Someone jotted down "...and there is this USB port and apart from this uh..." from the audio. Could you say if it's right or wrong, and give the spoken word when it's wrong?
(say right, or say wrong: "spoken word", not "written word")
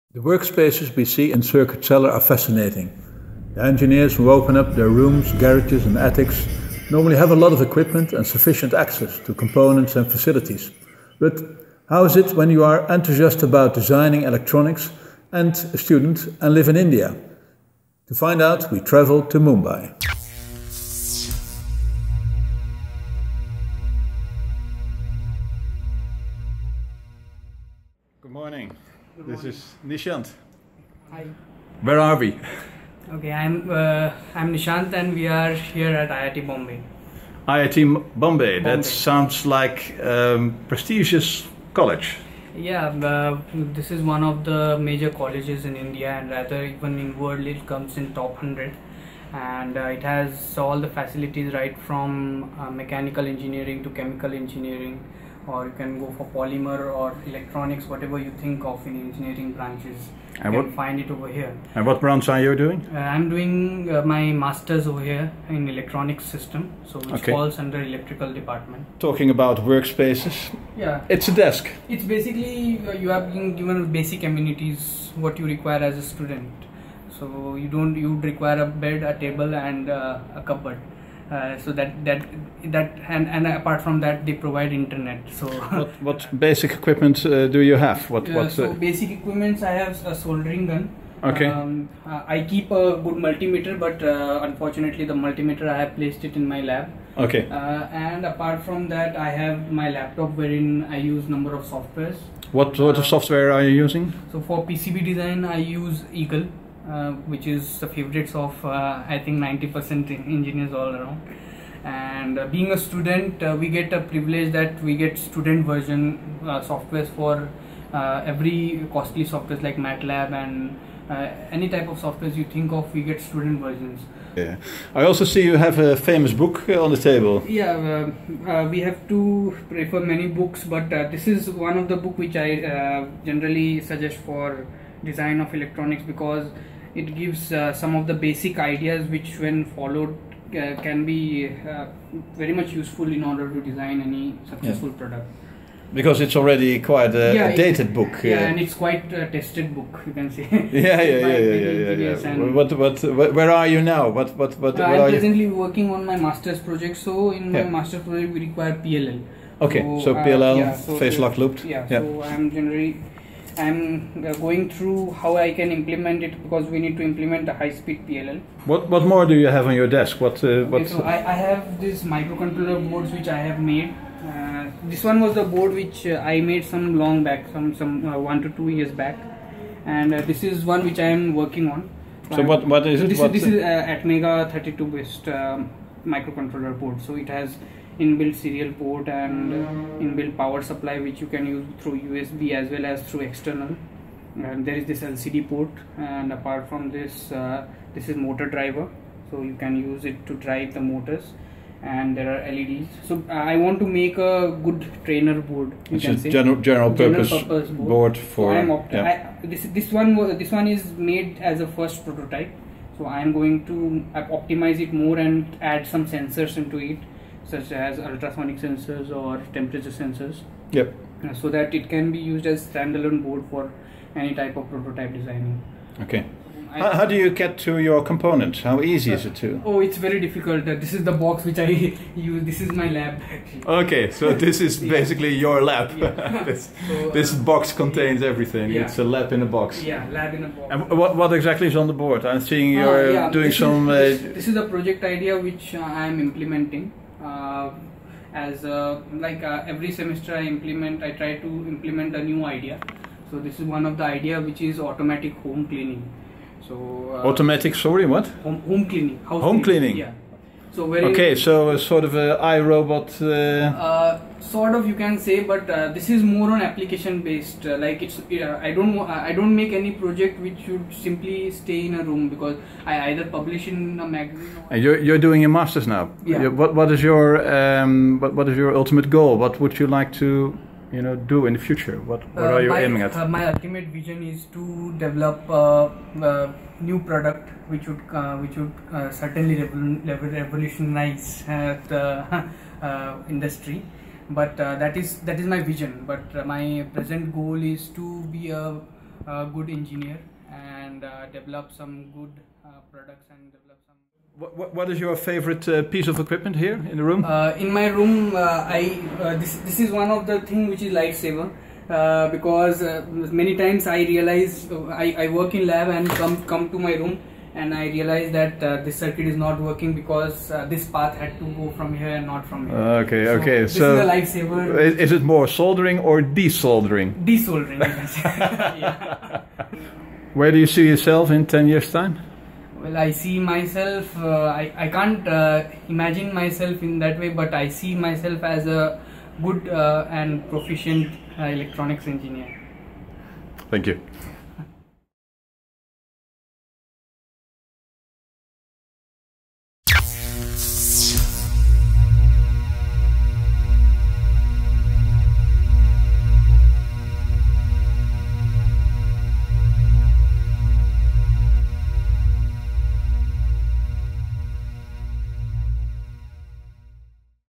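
wrong: "LCD", not "USB".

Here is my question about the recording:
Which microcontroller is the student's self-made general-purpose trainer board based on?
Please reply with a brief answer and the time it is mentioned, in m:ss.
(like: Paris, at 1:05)
ATmega 32, at 3:03.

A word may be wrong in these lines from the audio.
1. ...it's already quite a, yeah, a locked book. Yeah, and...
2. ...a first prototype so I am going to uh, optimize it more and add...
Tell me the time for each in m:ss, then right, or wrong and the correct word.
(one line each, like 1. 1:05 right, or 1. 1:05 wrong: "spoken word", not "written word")
1. 2:26 wrong: "dated", not "locked"
2. 3:31 right.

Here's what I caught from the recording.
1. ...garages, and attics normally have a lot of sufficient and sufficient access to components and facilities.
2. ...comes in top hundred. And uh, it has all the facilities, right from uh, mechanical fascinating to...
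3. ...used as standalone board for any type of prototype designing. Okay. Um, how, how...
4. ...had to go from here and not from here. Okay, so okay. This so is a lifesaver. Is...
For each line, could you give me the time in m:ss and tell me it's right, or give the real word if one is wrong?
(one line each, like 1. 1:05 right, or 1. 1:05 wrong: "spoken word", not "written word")
1. 0:05 wrong: "equipment", not "sufficient"
2. 0:47 wrong: "engineering", not "fascinating"
3. 3:42 right
4. 5:21 right.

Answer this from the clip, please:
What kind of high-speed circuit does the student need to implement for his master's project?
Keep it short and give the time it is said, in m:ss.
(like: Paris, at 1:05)
Phase locked loop, at 2:40.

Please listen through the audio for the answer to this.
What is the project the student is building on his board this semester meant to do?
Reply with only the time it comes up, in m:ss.
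4:14.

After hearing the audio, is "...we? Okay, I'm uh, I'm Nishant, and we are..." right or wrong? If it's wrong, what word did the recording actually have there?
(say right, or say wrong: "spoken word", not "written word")
right.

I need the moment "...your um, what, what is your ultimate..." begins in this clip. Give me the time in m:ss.
4:37.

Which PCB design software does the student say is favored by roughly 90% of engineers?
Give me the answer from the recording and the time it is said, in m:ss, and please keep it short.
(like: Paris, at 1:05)
Eagle, at 1:46.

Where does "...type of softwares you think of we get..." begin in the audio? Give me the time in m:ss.
2:01.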